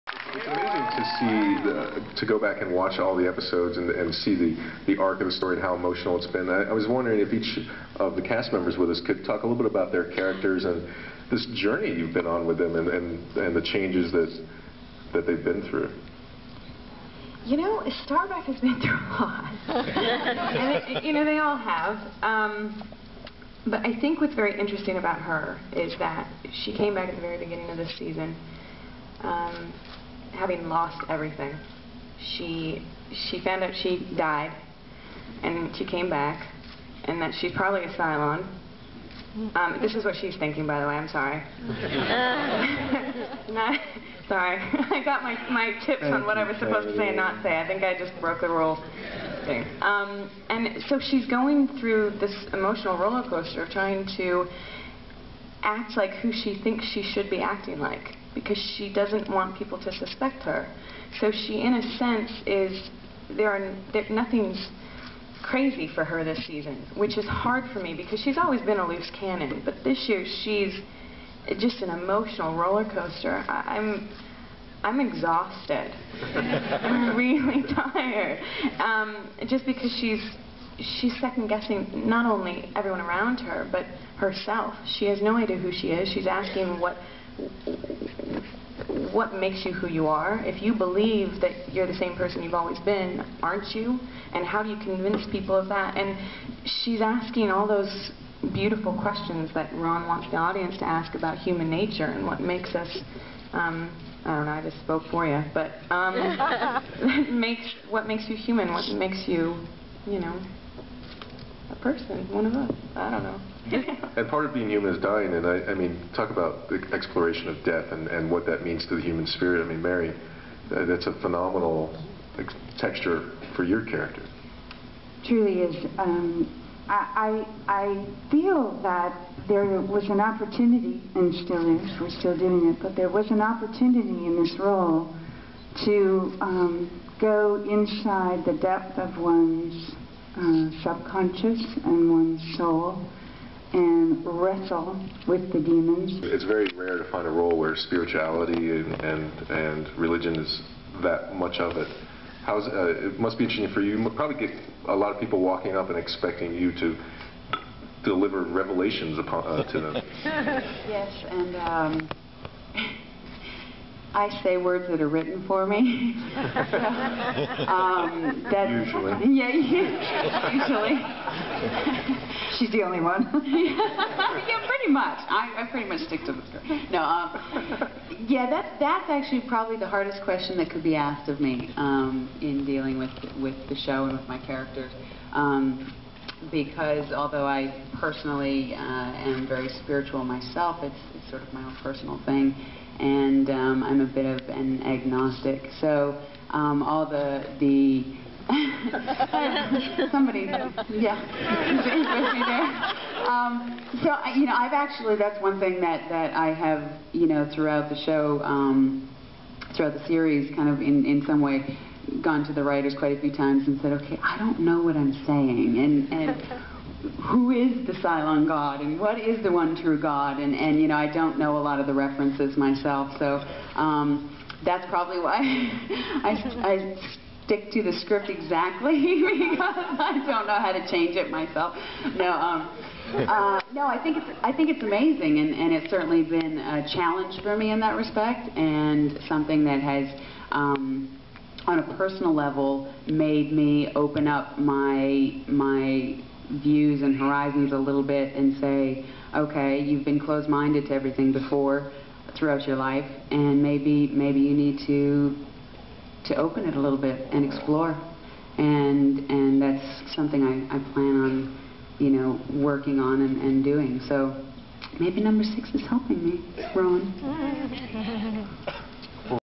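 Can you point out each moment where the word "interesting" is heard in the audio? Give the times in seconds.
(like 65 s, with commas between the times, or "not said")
24 s, 153 s.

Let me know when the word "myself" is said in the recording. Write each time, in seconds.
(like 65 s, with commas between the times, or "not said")
190 s, 222 s, 231 s.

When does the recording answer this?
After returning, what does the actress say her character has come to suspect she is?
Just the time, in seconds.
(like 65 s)
37 s.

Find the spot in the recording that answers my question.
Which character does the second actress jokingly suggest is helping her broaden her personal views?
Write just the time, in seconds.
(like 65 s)
265 s.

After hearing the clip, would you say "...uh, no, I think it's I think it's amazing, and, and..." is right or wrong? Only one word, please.
right.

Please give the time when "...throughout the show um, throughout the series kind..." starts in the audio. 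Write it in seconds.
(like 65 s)
207 s.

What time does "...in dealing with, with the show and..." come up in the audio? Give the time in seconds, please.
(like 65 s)
182 s.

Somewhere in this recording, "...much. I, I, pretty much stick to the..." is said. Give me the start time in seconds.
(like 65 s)
174 s.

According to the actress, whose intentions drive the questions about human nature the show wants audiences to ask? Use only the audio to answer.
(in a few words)
Ron.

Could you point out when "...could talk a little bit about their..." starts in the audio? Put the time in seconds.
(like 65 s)
9 s.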